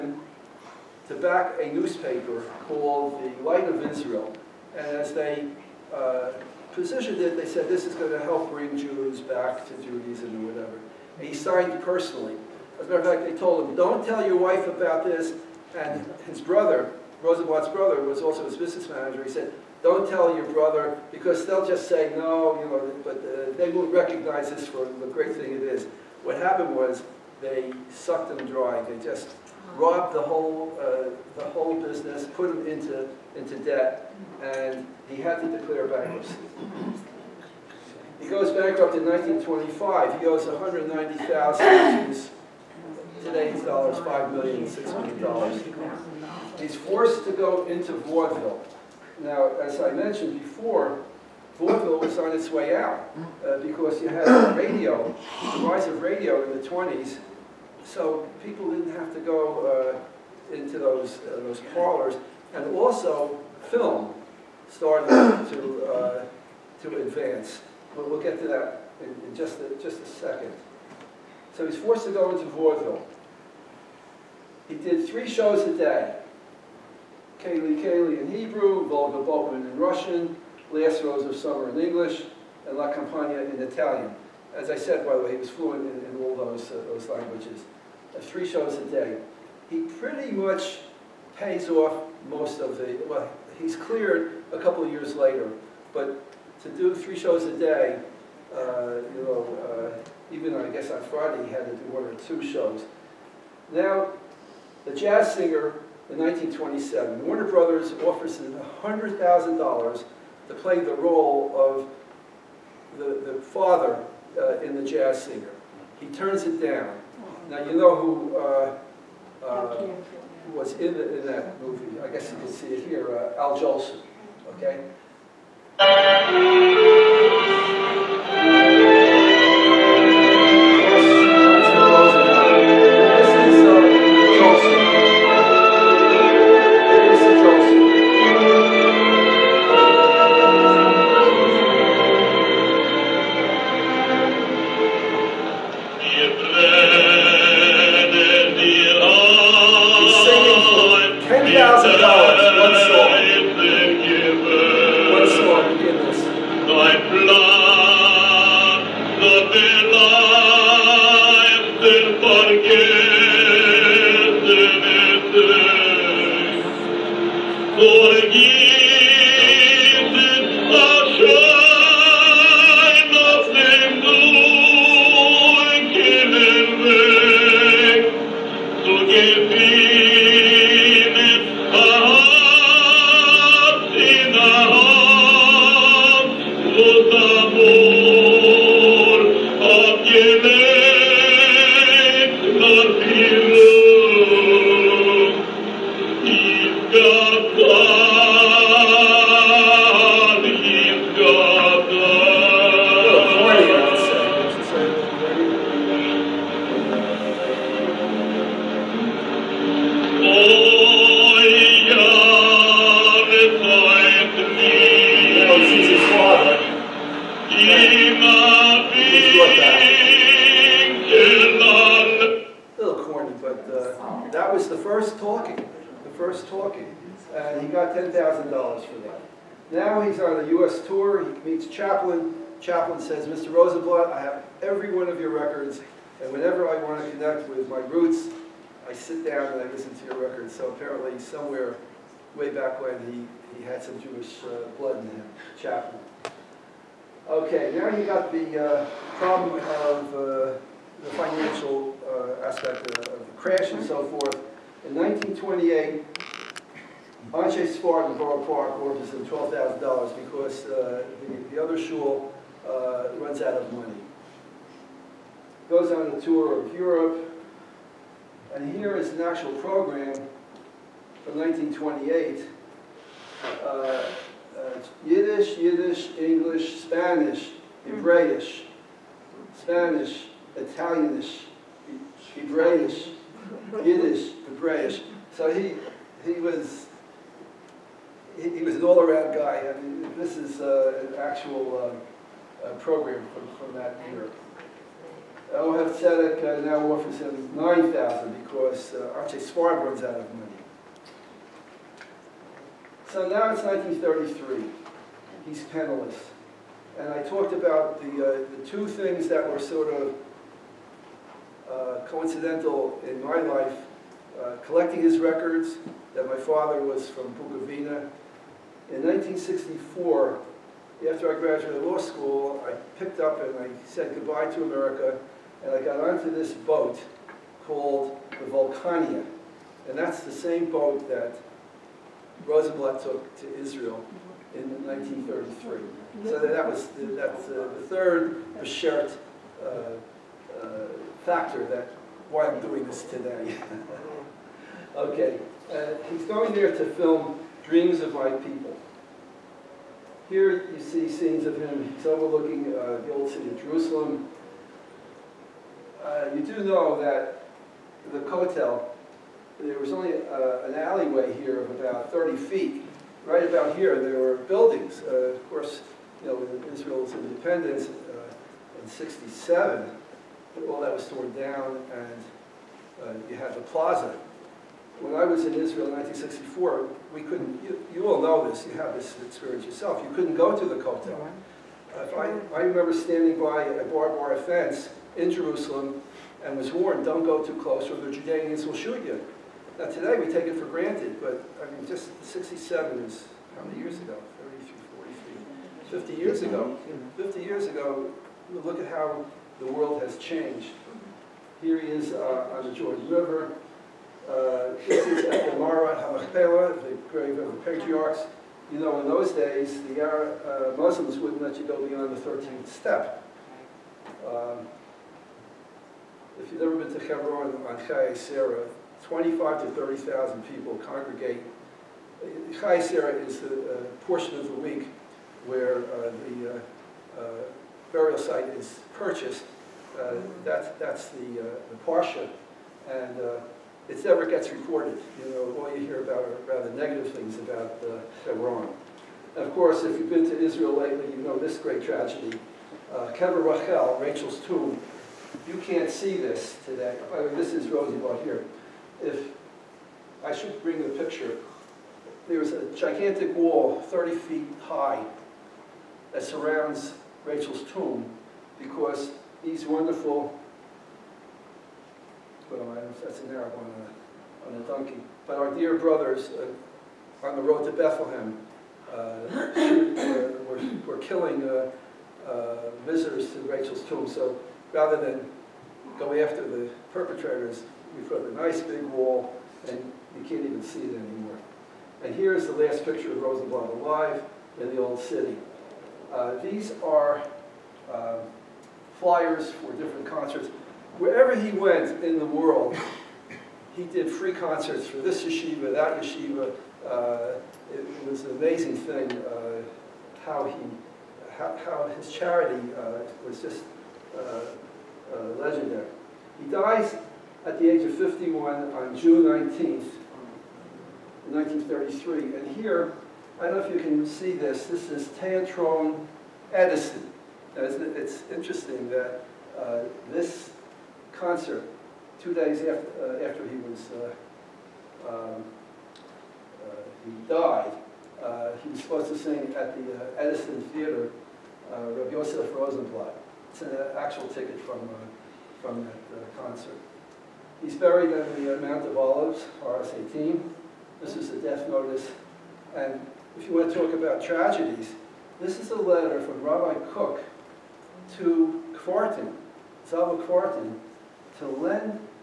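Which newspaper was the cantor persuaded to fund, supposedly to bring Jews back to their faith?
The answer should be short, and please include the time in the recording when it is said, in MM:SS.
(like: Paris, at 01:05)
The Light of Israel, at 00:03.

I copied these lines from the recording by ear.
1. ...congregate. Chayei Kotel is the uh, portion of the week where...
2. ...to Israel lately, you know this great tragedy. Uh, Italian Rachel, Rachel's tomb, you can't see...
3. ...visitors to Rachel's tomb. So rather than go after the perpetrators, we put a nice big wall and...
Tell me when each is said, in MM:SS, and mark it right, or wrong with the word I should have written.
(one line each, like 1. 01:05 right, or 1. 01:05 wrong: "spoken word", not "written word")
1. 07:00 wrong: "Sarah", not "Kotel"
2. 07:20 wrong: "Kever", not "Italian"
3. 07:52 right.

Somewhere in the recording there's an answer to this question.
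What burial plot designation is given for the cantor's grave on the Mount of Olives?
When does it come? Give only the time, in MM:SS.
08:59.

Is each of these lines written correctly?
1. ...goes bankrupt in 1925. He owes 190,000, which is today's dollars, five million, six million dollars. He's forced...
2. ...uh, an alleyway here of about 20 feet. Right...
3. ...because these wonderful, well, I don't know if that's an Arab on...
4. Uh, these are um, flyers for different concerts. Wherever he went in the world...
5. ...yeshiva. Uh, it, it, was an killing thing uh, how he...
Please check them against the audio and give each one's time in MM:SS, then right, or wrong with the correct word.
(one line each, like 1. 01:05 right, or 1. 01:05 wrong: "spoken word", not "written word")
1. 00:38 right
2. 06:00 wrong: "30", not "20"
3. 07:38 right
4. 08:06 right
5. 08:16 wrong: "amazing", not "killing".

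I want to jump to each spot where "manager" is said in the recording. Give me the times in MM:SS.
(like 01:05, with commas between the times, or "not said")
00:18.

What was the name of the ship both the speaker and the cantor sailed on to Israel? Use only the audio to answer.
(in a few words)
Vulcania.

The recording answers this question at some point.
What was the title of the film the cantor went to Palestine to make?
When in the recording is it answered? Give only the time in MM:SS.
05:47.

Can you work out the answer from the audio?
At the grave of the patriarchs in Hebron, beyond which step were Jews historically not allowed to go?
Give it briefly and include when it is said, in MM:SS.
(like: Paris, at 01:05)
13th step, at 06:52.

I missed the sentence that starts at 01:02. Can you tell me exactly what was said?
And also, film started to, uh, to advance.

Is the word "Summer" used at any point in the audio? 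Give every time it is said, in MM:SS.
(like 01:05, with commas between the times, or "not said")
01:21.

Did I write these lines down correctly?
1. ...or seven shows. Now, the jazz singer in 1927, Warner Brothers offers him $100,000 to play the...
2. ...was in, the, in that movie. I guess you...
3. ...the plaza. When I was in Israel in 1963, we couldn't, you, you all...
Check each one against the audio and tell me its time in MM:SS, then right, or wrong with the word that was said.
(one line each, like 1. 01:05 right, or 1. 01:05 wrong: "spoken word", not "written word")
1. 01:42 wrong: "two", not "seven"
2. 02:00 right
3. 06:13 wrong: "1964", not "1963".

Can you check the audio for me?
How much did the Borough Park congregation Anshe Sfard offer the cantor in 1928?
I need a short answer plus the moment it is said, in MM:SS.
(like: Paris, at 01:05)
$12,000, at 04:19.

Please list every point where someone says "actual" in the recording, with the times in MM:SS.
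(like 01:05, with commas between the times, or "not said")
04:29, 04:51, 08:53.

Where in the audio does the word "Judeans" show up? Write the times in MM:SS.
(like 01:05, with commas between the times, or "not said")
06:28.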